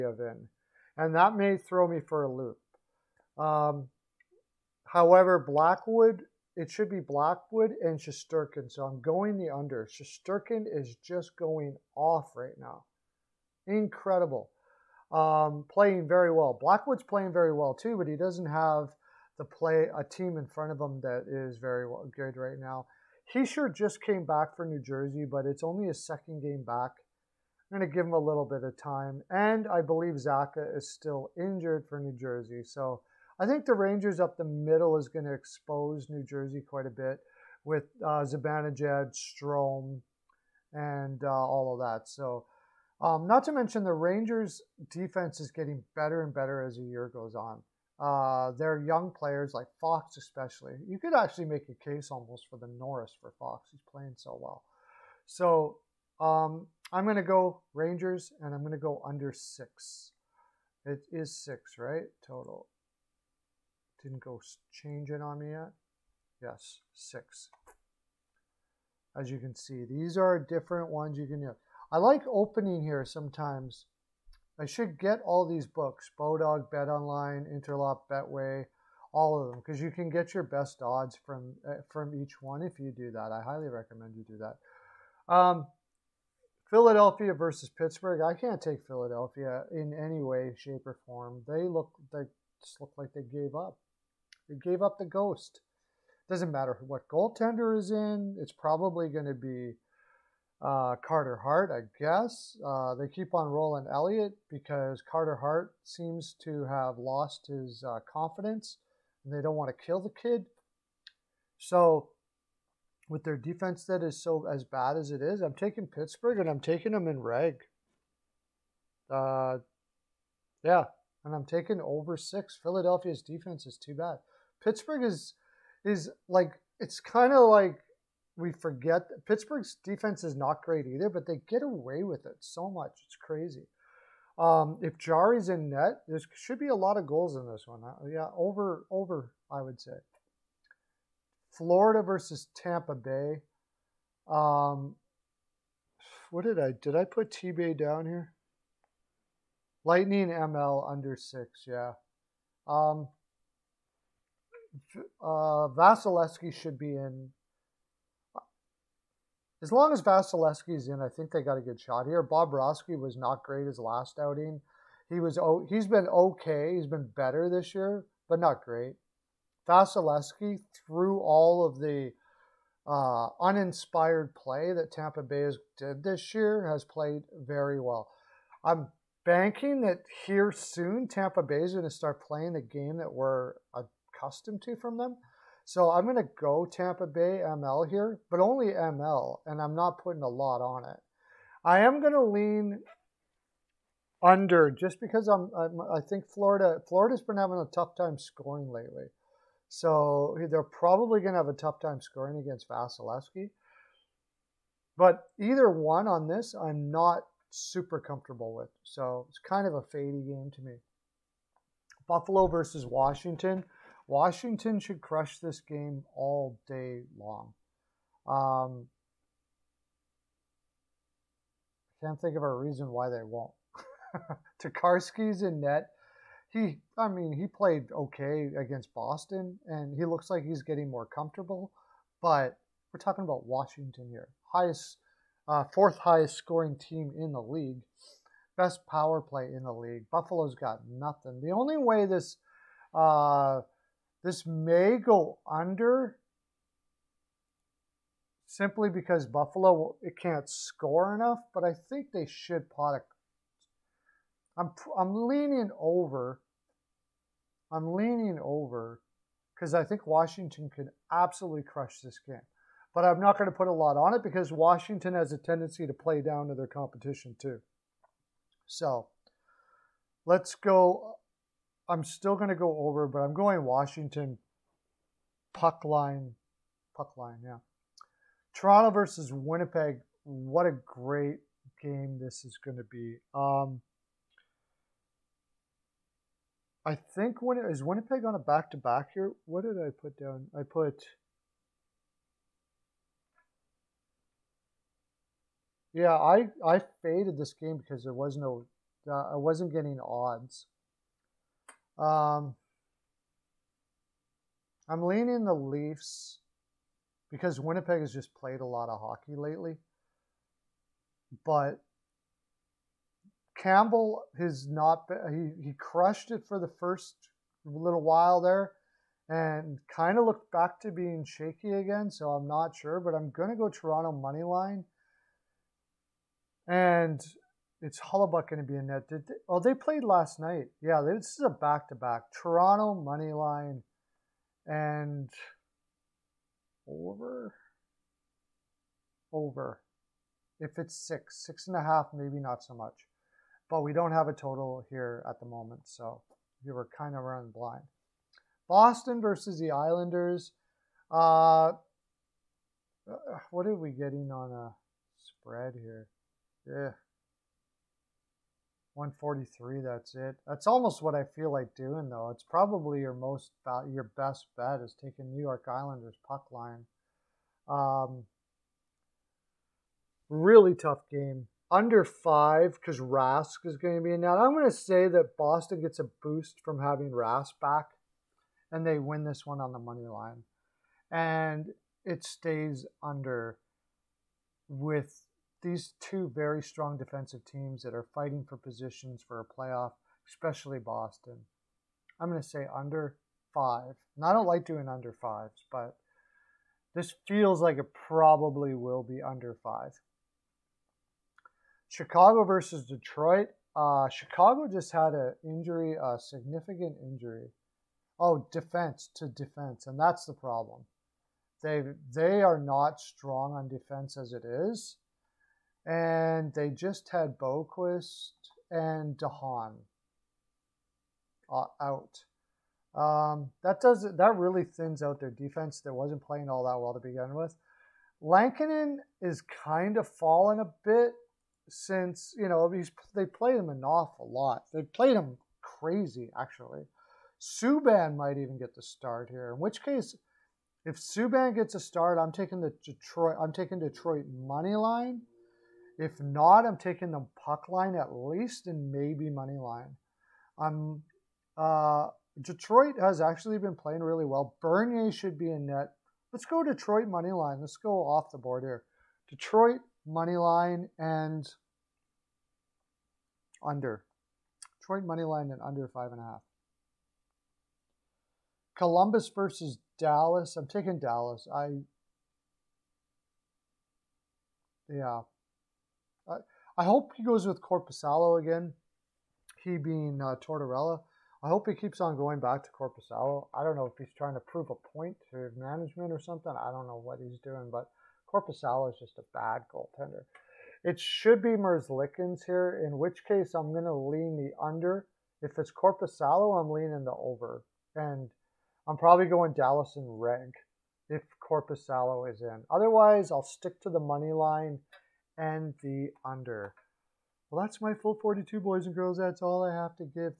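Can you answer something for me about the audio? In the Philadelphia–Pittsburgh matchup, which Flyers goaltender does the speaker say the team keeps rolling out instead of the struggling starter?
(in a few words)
Elliott.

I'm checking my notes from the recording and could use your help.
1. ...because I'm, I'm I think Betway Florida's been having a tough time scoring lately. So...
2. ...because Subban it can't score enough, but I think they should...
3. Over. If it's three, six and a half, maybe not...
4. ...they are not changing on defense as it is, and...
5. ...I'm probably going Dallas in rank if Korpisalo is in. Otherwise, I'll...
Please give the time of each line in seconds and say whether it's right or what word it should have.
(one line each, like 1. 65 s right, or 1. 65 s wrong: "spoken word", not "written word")
1. 194 s wrong: "Florida", not "Betway"
2. 248 s wrong: "Buffalo", not "Subban"
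3. 339 s wrong: "six", not "three"
4. 412 s wrong: "strong", not "changing"
5. 498 s right.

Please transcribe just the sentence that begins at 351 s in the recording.
Uh, uh what are we getting on a spread here?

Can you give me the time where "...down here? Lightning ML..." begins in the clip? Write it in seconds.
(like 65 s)
147 s.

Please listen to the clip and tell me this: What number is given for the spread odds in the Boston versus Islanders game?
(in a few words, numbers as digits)
143.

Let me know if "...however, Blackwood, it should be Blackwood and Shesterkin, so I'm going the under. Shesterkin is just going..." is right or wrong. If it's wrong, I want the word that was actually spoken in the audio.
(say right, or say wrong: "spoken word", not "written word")
right.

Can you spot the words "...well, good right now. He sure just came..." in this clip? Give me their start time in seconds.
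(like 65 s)
21 s.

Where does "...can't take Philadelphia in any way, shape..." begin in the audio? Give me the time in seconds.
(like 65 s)
88 s.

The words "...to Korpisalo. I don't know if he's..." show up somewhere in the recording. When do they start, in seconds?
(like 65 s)
482 s.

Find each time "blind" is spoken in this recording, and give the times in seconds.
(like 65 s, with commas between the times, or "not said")
347 s.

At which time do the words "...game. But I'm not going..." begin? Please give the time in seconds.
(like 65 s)
262 s.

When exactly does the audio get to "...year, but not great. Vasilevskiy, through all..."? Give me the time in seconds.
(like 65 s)
167 s.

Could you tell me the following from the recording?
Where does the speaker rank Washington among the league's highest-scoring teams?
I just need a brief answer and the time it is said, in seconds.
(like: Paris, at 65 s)
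Fourth, at 235 s.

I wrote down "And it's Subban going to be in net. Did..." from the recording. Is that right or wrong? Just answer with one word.
wrong.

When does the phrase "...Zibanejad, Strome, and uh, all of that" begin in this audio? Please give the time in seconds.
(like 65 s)
38 s.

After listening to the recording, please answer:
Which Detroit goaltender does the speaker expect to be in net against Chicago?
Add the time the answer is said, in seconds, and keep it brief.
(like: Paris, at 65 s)
Bernier, at 454 s.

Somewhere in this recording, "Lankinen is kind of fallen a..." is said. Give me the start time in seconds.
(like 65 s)
428 s.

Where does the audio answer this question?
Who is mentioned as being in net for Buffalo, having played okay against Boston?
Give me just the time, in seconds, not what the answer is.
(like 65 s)
224 s.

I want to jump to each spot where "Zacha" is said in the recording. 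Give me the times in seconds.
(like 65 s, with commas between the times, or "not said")
30 s.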